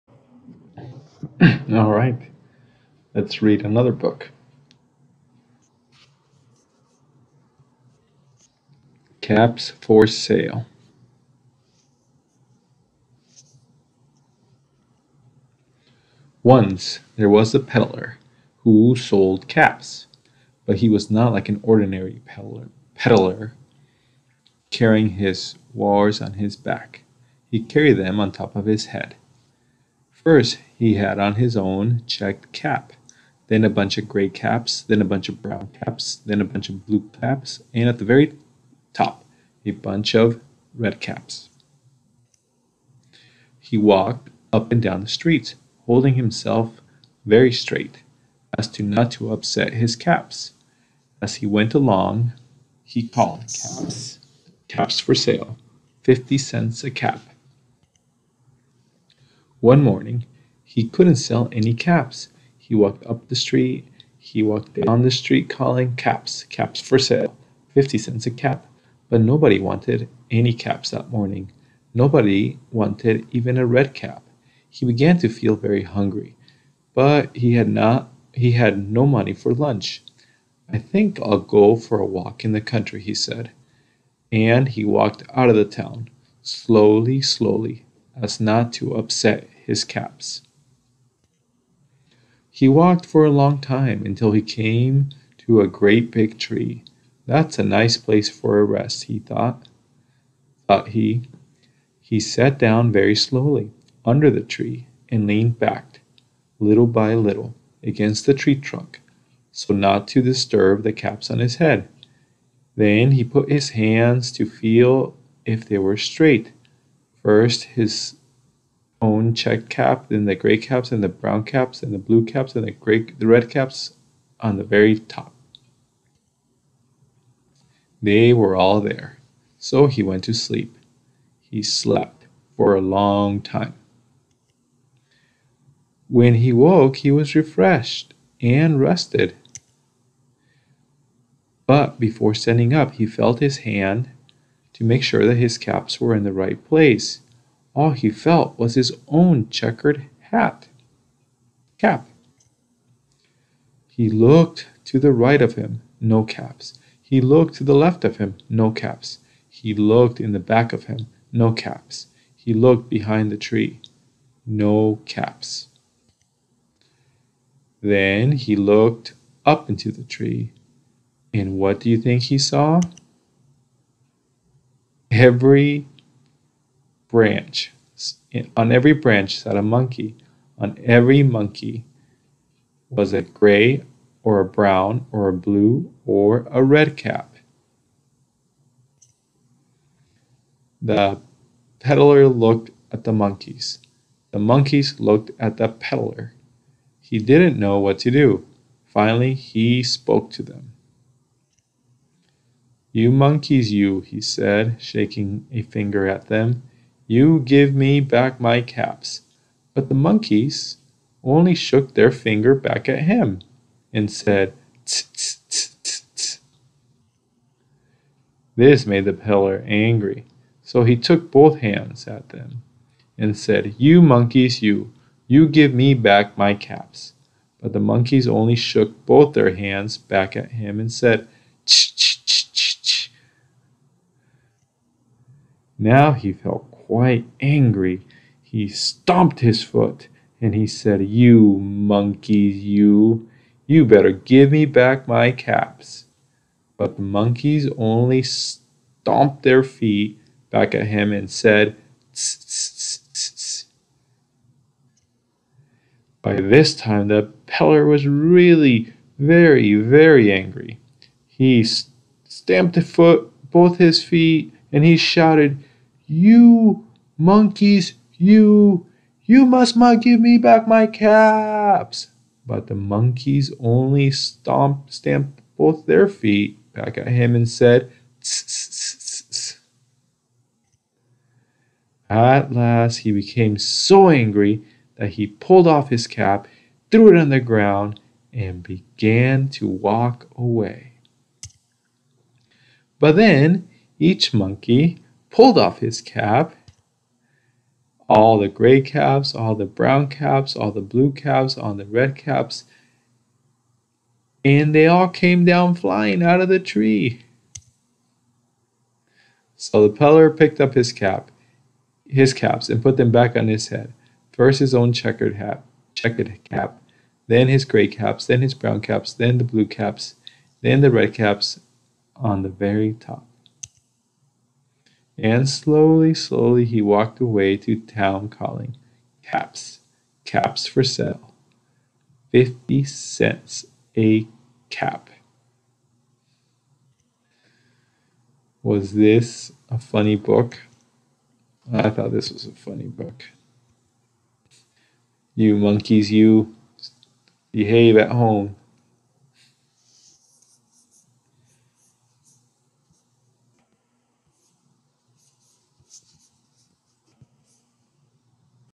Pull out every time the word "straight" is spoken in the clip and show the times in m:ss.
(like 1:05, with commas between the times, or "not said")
0:47, 1:55.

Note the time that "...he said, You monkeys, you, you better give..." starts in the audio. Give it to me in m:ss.
4:00.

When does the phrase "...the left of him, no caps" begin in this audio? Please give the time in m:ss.
2:37.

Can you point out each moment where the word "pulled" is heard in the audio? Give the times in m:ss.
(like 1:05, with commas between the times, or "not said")
4:45, 4:55.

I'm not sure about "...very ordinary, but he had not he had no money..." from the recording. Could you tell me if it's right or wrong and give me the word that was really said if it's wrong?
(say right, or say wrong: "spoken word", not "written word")
wrong: "hungry", not "ordinary".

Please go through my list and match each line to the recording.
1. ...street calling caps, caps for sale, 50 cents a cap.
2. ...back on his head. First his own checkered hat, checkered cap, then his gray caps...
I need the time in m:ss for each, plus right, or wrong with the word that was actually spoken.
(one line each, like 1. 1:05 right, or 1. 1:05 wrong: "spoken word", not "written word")
1. 1:05 right
2. 5:13 right.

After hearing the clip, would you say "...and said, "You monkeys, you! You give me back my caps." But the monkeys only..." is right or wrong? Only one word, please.
right.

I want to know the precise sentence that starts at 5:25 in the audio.
And slowly, slowly he walked away to town calling, Caps, caps for sale.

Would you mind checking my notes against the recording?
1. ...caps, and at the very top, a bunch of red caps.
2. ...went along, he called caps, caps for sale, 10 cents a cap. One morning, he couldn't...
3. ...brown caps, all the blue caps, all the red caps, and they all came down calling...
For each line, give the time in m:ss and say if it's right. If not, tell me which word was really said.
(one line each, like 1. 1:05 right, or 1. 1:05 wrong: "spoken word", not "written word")
1. 0:37 right
2. 0:51 wrong: "50", not "10"
3. 4:59 wrong: "flying", not "calling".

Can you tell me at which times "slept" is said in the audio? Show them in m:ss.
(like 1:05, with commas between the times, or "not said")
2:11.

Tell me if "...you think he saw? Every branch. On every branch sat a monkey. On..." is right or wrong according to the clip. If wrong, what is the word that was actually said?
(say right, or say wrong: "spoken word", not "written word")
right.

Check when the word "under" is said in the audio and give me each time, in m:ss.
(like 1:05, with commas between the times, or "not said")
1:44.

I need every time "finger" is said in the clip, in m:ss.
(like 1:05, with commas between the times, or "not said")
3:25, 3:32.